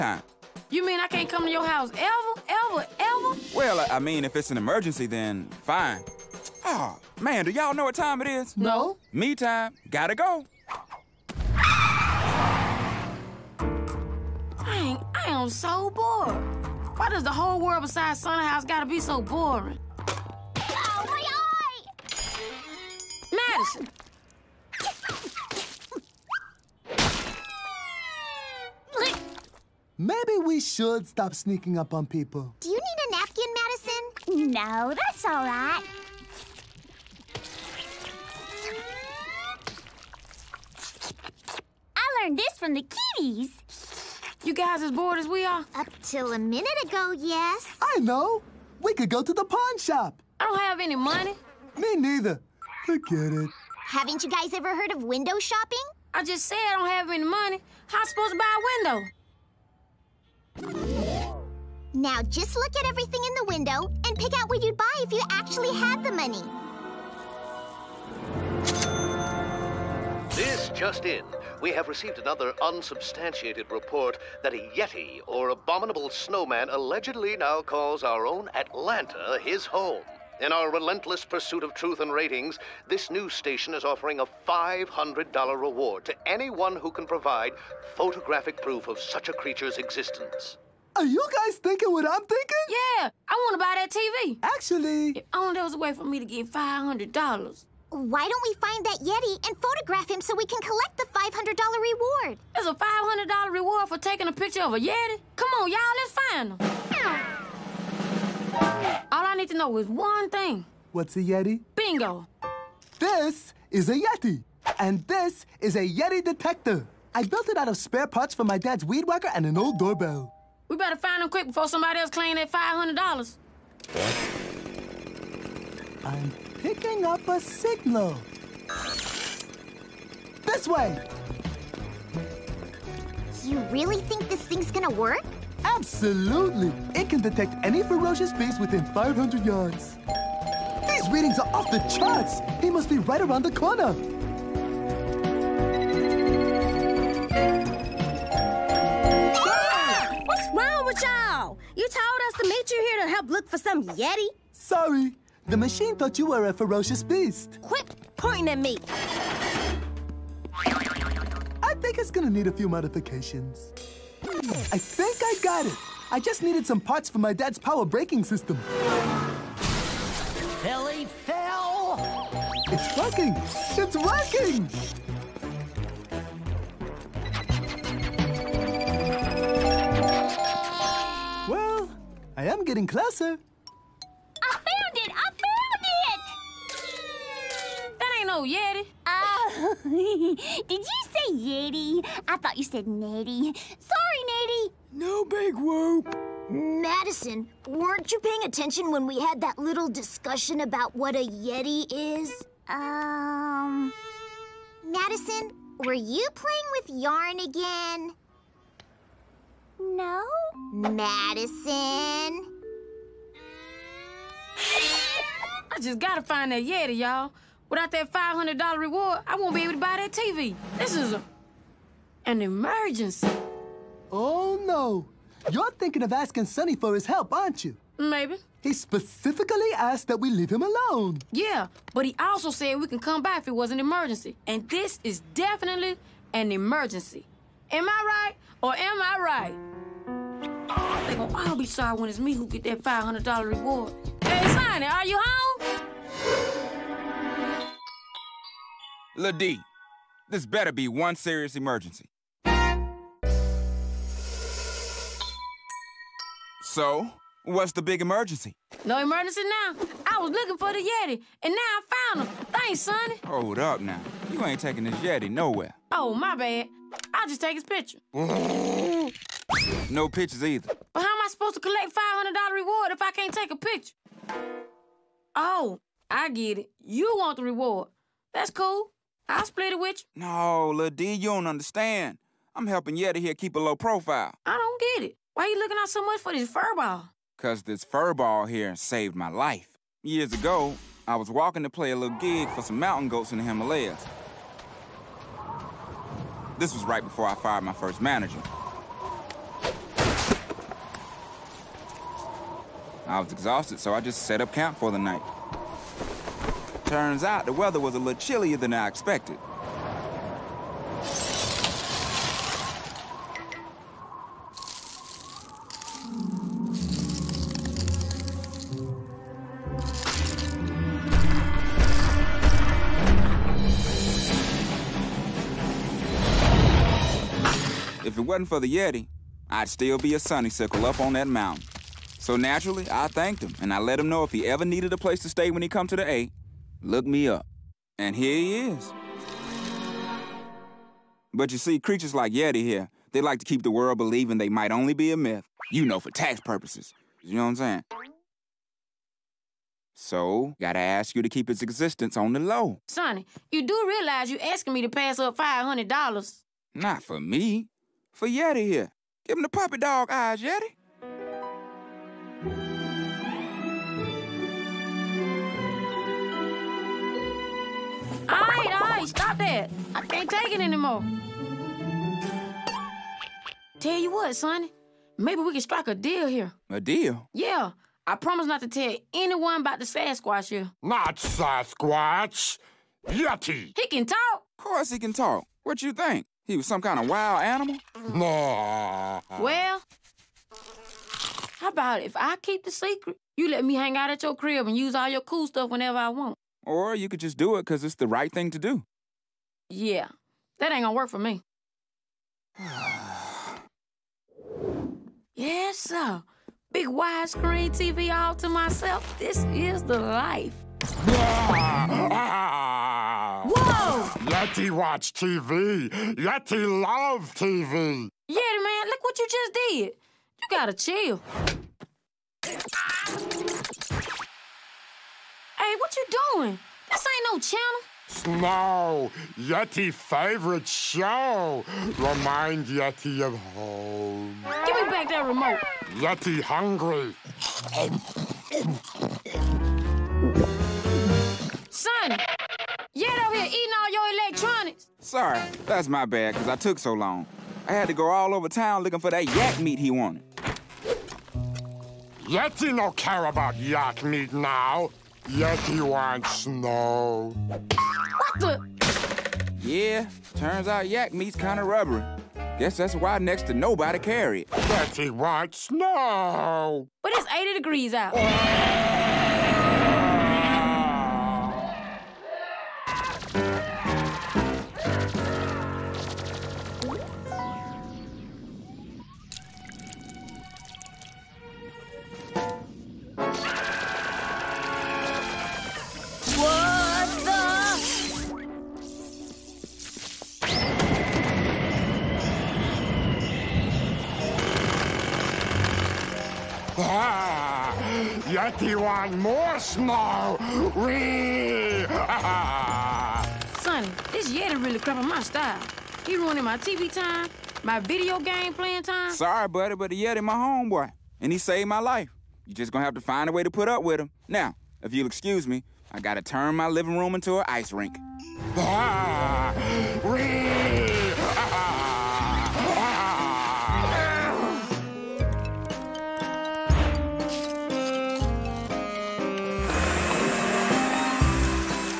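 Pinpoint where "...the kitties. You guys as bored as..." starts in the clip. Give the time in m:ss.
0:42.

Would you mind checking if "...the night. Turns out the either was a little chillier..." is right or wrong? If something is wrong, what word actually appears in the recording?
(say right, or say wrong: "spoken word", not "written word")
wrong: "weather", not "either".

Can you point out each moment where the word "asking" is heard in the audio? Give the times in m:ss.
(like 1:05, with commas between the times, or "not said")
3:46, 5:54.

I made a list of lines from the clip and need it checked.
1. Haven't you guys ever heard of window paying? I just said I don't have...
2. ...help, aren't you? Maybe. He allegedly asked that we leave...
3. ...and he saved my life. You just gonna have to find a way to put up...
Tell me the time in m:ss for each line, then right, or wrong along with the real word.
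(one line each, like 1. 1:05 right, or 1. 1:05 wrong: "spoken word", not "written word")
1. 0:53 wrong: "shopping", not "paying"
2. 3:47 wrong: "specifically", not "allegedly"
3. 8:31 right.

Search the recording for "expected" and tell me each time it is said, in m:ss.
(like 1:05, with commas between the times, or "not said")
5:08.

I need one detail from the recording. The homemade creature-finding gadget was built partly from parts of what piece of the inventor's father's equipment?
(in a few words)
weed whacker.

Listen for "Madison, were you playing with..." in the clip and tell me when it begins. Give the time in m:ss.
3:24.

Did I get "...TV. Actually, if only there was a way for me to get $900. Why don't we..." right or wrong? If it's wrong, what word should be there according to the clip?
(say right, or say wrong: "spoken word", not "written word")
wrong: "500", not "900".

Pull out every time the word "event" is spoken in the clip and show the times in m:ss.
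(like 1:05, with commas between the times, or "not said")
not said.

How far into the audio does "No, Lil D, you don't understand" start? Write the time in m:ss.
4:40.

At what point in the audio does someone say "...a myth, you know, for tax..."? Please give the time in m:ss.
5:45.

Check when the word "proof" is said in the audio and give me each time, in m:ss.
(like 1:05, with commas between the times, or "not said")
1:28.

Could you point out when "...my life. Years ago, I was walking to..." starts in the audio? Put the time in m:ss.
4:49.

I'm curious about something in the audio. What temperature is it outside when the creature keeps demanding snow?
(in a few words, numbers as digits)
80 degrees.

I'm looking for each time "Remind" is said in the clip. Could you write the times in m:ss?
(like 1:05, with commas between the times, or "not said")
7:11.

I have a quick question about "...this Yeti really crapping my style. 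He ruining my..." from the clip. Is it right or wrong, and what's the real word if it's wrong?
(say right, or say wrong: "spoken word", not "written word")
right.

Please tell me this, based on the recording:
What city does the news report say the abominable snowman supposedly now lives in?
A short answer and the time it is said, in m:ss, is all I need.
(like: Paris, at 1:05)
Atlanta, at 1:18.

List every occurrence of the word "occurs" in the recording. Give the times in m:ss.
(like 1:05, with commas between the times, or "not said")
not said.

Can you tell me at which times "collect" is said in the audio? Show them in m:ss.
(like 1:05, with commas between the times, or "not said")
1:40, 4:31.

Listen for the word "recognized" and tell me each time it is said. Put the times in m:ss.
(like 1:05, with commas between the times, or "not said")
not said.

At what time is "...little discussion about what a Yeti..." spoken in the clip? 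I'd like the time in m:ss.
3:19.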